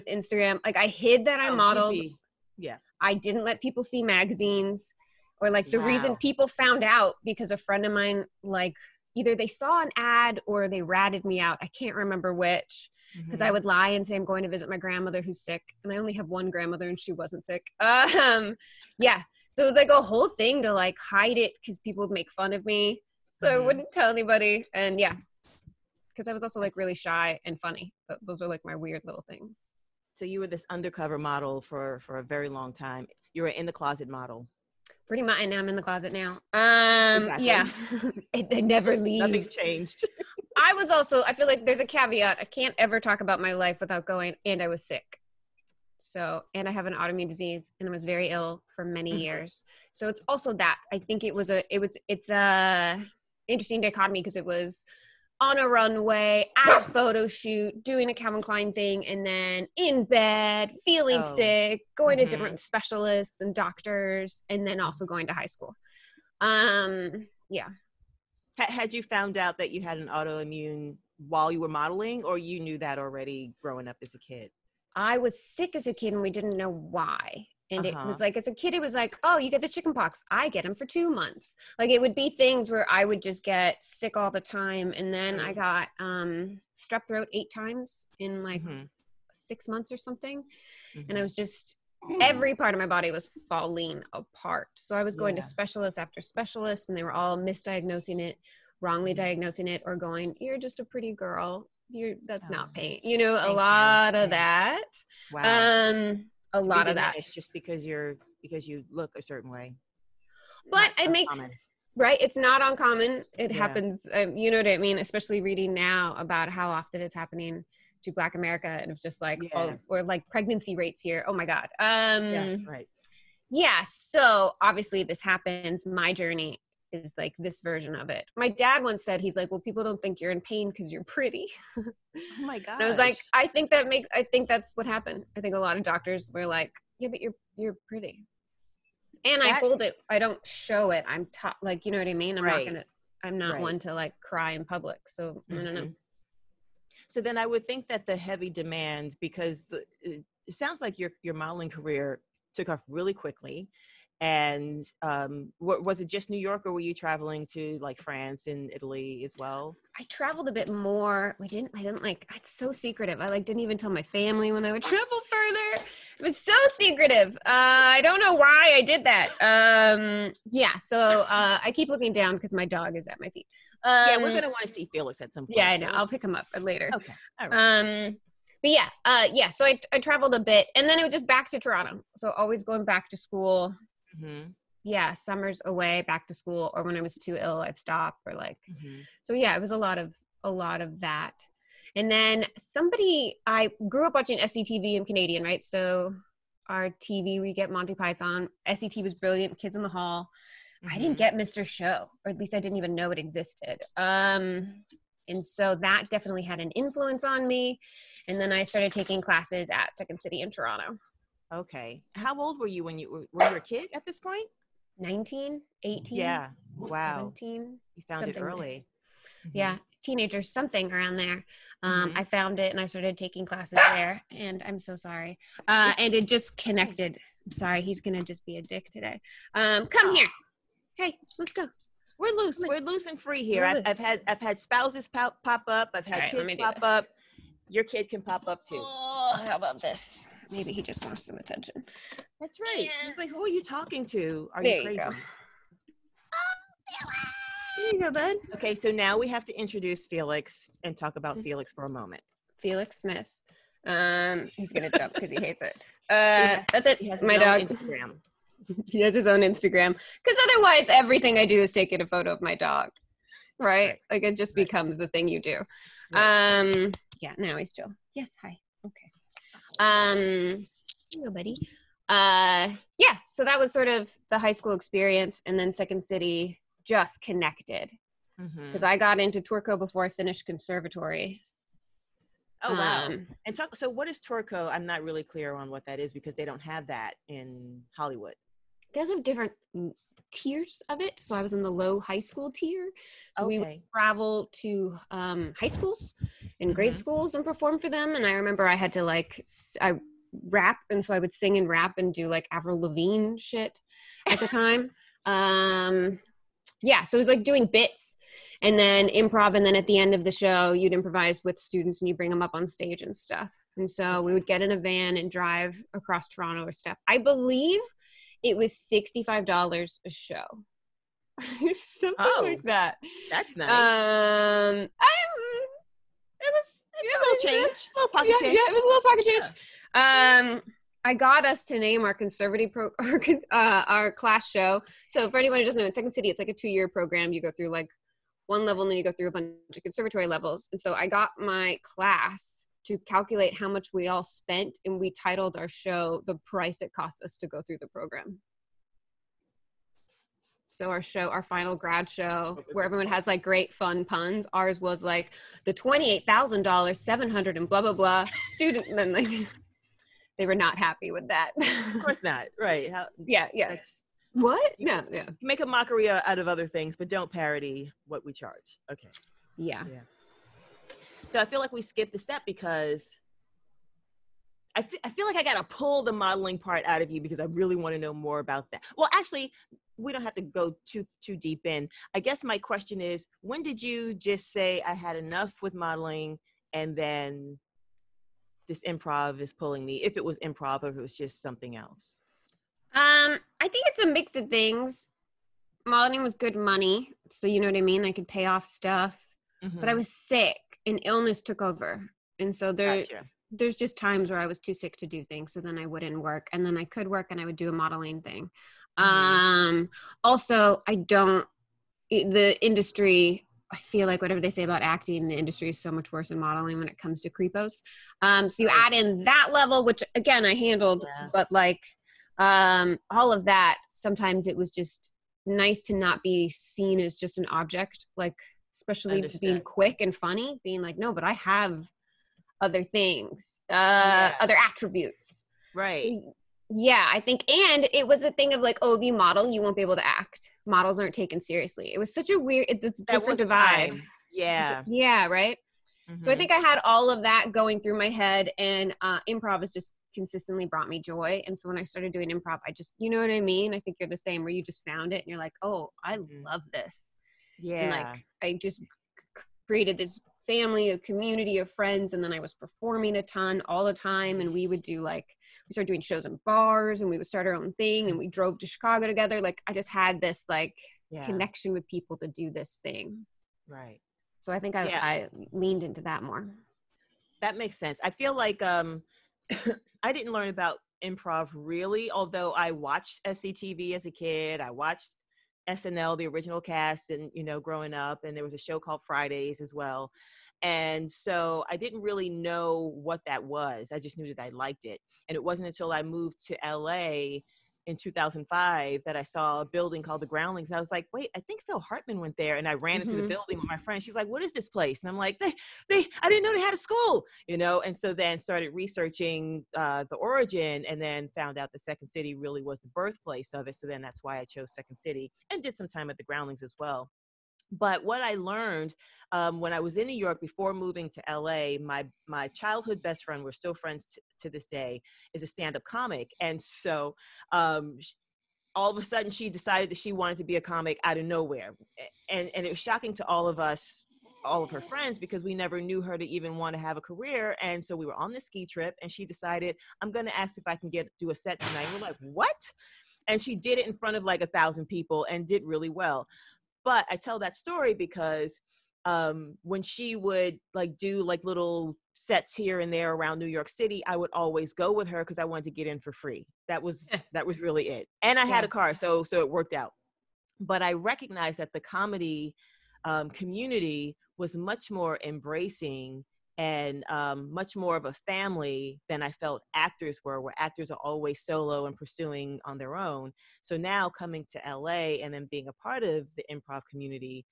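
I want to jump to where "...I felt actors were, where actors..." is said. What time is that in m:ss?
9:29.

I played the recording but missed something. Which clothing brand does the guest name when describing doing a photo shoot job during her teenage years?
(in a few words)
Calvin Klein.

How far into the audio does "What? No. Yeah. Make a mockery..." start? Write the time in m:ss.
6:04.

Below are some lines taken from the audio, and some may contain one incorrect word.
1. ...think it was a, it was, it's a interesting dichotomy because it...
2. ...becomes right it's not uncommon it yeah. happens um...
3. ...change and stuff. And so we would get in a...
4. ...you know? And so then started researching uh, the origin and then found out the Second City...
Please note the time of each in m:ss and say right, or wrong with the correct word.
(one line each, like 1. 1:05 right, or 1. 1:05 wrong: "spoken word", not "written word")
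1. 0:50 right
2. 1:51 wrong: "makes", not "becomes"
3. 5:12 wrong: "stage", not "change"
4. 8:27 right.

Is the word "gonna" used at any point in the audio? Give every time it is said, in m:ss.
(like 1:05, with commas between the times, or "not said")
2:54, 4:14.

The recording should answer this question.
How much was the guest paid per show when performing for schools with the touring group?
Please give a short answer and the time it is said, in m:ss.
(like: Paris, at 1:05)
$65, at 5:18.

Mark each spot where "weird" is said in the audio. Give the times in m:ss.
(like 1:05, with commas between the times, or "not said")
0:28, 7:22.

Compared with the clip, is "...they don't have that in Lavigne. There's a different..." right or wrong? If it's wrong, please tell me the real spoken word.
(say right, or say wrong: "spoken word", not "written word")
wrong: "Hollywood", not "Lavigne".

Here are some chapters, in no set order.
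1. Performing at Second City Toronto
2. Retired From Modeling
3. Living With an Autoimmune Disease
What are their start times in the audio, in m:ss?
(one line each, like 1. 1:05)
1. 3:31
2. 6:26
3. 0:49.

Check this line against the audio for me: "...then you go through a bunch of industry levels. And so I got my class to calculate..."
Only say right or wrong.
wrong.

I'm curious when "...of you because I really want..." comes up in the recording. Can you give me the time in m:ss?
6:17.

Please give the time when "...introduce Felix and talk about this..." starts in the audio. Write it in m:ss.
4:09.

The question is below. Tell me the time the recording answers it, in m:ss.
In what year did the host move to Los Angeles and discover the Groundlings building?
8:17.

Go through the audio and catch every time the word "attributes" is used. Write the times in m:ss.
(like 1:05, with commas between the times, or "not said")
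7:14.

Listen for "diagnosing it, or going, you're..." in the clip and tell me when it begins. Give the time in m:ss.
1:39.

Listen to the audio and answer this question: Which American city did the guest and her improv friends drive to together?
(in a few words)
Chicago.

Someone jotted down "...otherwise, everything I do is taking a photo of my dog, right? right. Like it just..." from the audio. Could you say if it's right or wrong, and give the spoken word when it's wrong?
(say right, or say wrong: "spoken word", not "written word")
right.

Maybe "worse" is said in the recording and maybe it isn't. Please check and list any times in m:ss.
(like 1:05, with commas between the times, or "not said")
6:56.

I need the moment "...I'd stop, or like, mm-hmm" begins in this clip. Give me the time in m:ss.
3:07.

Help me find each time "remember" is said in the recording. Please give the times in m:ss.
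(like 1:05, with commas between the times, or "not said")
0:11, 4:58.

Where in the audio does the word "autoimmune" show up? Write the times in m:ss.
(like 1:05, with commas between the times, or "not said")
0:46, 1:10.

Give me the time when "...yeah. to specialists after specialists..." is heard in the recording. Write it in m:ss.
1:35.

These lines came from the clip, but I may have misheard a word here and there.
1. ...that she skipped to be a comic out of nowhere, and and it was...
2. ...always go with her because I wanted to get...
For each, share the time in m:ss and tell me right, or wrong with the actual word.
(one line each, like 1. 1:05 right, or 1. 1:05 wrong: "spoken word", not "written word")
1. 8:49 wrong: "wanted", not "skipped"
2. 9:14 right.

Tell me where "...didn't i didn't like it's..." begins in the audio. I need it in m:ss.
2:41.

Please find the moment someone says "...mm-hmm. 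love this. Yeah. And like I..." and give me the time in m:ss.
7:36.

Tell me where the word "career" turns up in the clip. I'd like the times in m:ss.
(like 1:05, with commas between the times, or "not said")
2:31, 8:57.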